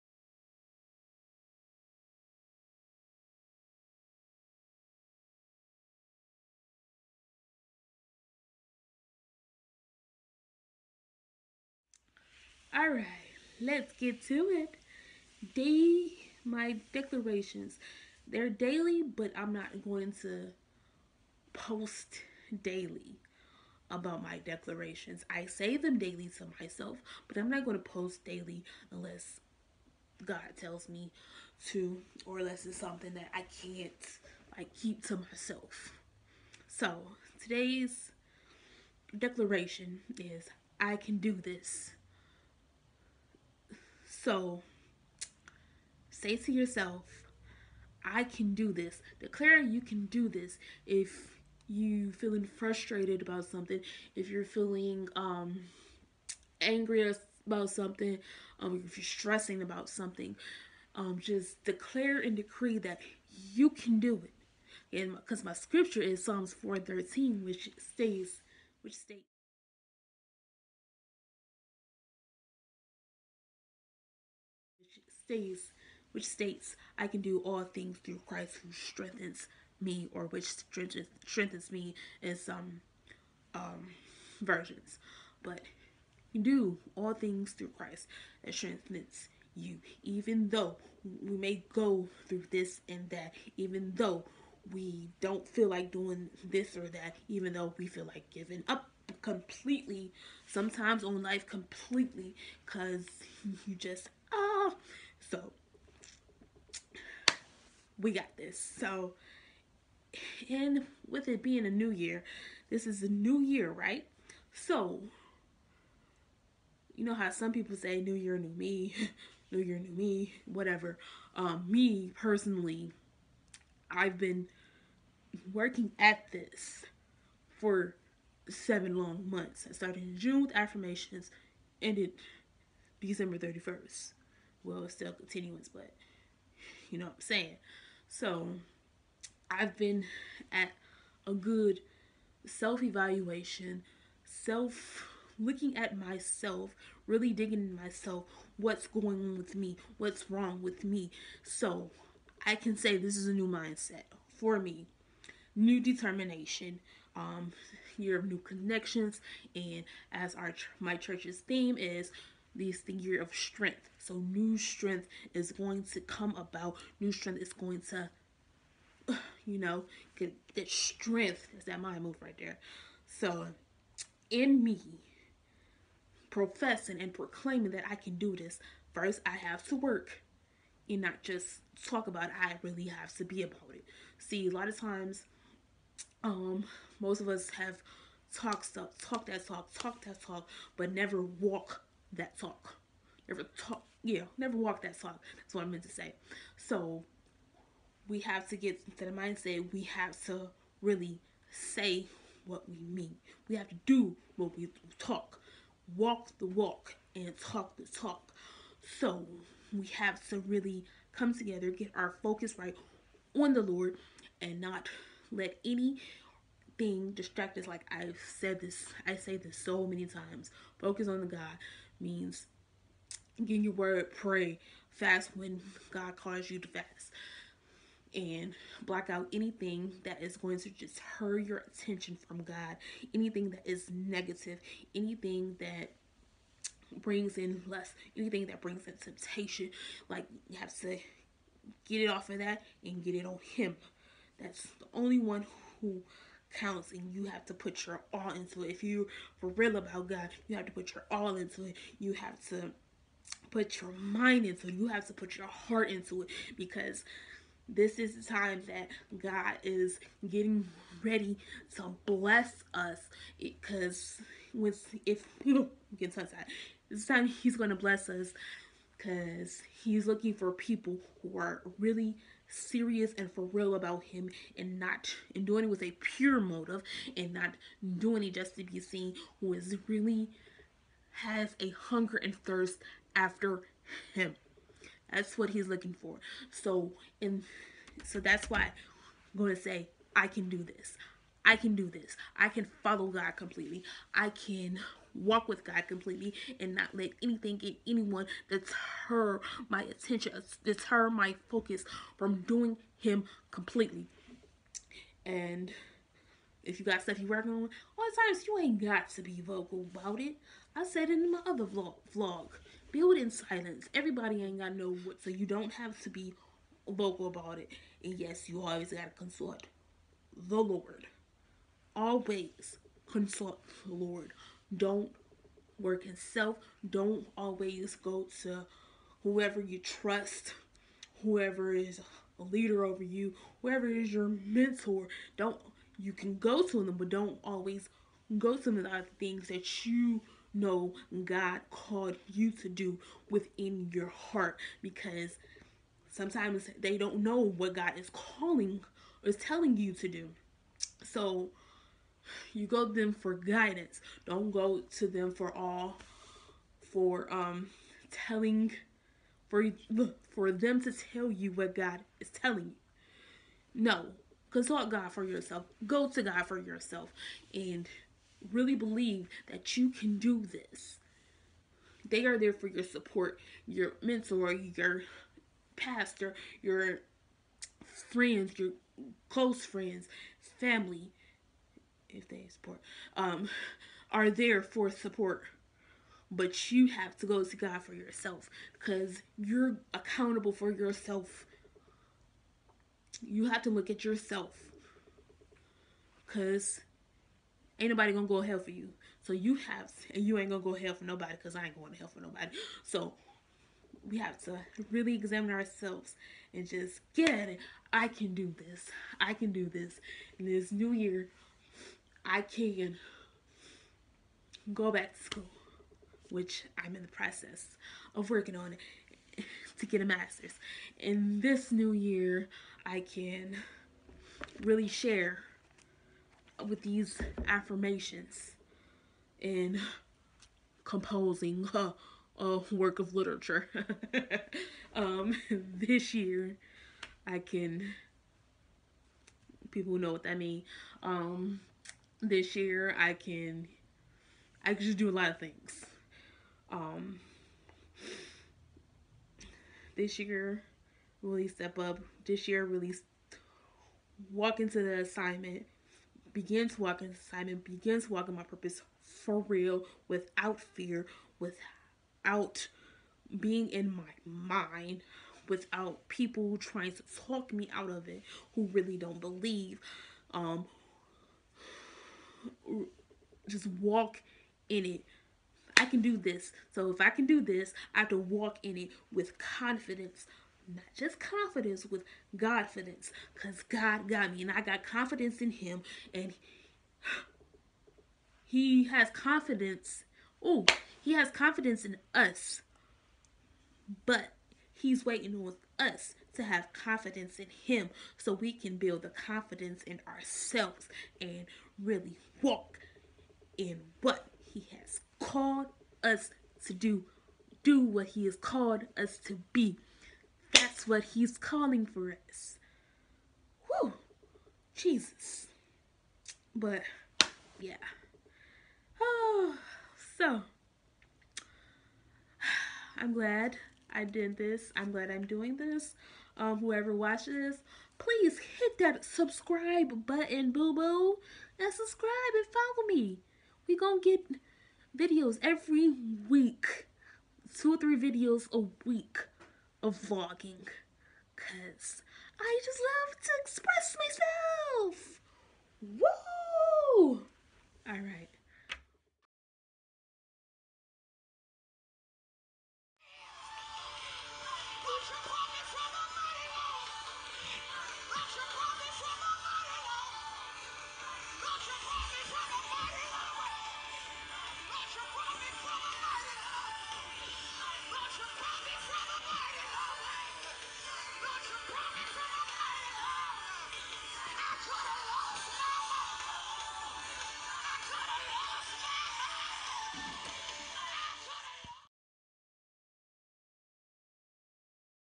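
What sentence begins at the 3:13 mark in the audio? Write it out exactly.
Never talk yeah, never walk that talk.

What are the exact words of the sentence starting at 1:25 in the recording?
But do all things through Christ that strengthens you.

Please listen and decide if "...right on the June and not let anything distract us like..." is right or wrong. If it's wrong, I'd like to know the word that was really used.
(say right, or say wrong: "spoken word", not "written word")
wrong: "Lord", not "June".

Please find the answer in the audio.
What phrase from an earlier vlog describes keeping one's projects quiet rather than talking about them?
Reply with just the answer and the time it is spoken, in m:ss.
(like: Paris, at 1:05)
build in silence, at 5:12.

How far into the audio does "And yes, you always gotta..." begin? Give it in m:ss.
5:18.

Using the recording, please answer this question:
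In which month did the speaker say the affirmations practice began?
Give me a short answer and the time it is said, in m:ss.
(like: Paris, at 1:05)
June, at 2:10.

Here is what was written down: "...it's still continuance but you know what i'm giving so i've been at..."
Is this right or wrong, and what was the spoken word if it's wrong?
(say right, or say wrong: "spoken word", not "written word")
wrong: "saying", not "giving".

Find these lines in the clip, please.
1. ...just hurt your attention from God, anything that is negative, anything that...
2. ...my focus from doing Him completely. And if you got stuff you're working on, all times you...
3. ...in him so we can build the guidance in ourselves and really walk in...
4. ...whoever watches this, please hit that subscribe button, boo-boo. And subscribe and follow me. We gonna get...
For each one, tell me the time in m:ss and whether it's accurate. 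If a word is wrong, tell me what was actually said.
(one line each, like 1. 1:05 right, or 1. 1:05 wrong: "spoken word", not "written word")
1. 3:50 right
2. 5:01 right
3. 8:17 wrong: "confidence", not "guidance"
4. 8:46 right.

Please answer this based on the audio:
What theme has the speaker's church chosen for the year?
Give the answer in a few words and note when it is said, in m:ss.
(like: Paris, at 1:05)
the year of strength, at 2:42.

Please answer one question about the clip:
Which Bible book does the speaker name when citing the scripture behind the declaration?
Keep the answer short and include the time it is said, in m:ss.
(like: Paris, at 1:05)
Psalms, at 1:06.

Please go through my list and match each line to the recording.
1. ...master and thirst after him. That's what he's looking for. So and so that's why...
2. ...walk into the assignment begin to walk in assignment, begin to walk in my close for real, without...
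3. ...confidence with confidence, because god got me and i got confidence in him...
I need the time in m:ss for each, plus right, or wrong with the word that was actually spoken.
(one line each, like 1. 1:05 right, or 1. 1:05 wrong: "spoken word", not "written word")
1. 4:41 wrong: "hunger", not "master"
2. 7:34 wrong: "purpose", not "close"
3. 8:01 right.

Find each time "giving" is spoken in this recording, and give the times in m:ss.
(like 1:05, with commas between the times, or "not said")
1:38.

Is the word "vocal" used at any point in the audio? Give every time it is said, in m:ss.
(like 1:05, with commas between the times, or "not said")
5:09, 5:16.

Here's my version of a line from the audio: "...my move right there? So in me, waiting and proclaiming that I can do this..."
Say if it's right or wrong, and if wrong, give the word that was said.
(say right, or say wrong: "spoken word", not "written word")
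wrong: "professing", not "waiting".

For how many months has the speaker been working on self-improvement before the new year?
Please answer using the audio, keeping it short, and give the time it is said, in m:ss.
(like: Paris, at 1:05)
7, at 2:08.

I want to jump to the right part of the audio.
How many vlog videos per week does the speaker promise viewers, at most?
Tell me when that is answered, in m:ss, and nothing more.
8:57.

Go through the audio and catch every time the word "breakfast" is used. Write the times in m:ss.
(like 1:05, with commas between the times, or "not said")
not said.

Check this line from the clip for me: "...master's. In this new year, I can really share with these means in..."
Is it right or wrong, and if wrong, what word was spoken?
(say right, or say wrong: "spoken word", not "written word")
wrong: "affirmations", not "means".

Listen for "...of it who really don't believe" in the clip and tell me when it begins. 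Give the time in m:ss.
7:47.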